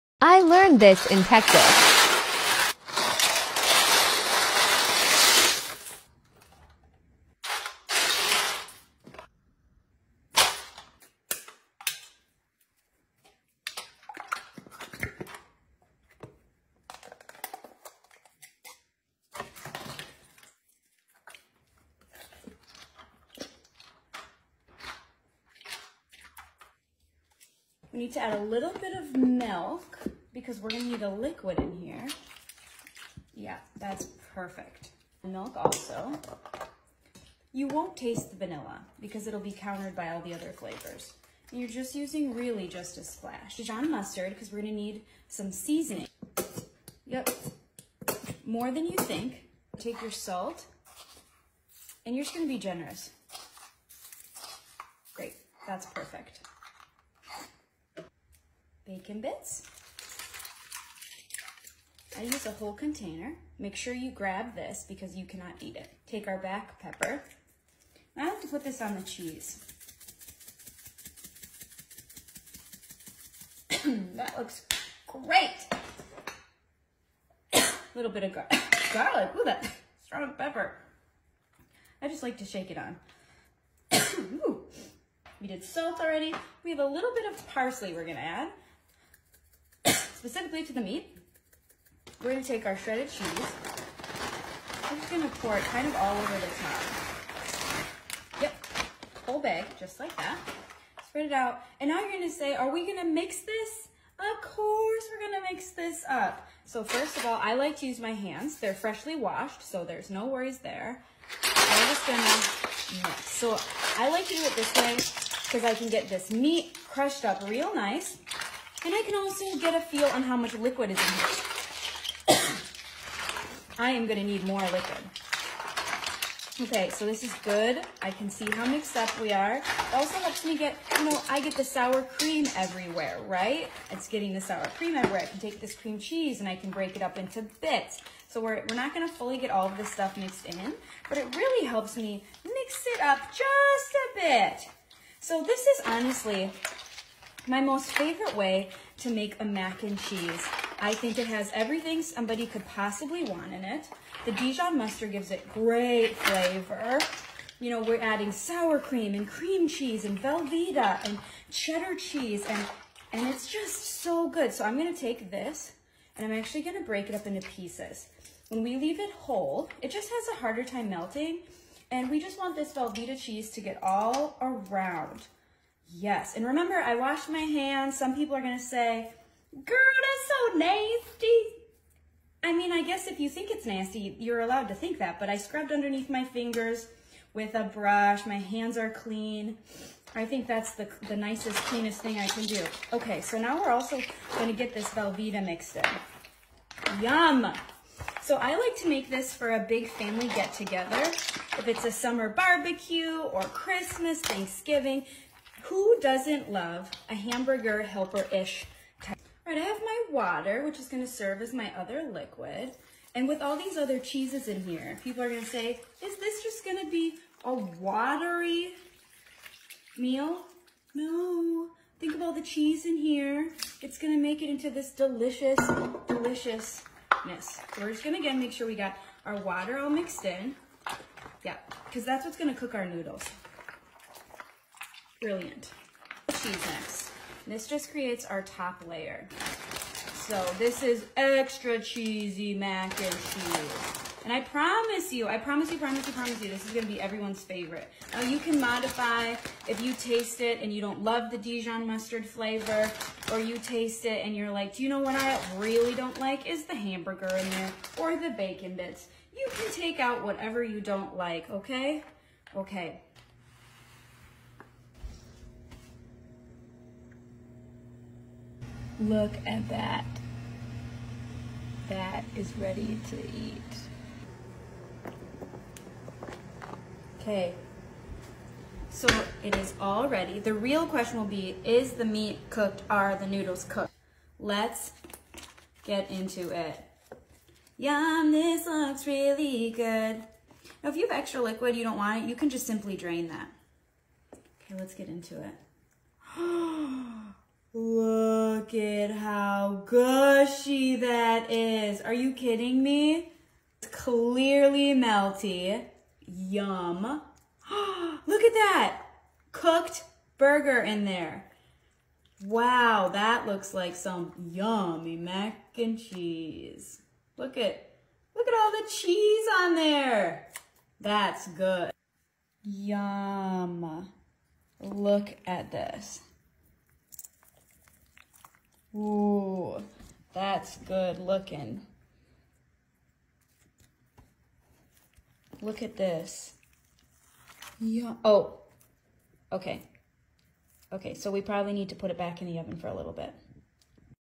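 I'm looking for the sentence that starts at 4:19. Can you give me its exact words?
You can take out whatever you don't like, okay?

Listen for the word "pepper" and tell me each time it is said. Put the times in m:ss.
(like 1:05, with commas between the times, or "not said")
1:06, 1:20.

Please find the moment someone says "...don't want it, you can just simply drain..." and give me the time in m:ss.
4:51.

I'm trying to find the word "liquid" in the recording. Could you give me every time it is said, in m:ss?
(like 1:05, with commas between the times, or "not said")
0:31, 2:00, 2:04, 3:32, 4:51.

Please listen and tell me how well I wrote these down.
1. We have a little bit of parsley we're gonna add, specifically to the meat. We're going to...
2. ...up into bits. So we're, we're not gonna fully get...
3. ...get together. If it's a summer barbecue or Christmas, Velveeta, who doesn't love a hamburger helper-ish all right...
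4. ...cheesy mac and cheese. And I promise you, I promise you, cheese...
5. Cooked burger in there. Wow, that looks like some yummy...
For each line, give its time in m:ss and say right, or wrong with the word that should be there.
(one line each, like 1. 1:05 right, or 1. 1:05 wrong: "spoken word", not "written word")
1. 1:26 right
2. 2:17 right
3. 3:20 wrong: "Thanksgiving", not "Velveeta"
4. 4:01 wrong: "promise", not "cheese"
5. 5:09 right.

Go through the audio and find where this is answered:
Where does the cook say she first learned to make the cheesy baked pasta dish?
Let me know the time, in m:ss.
0:01.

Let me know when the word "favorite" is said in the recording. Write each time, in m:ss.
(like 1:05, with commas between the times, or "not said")
2:27, 4:07.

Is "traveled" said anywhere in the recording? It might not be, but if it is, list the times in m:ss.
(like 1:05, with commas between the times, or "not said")
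not said.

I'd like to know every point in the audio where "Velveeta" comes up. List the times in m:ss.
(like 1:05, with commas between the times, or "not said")
2:40, 2:52, 3:14.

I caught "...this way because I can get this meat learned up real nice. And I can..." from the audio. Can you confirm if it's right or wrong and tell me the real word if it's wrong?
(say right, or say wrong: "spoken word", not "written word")
wrong: "crushed", not "learned".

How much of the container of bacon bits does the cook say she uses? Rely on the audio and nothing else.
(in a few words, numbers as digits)
A whole container.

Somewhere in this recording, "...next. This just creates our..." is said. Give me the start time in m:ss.
3:56.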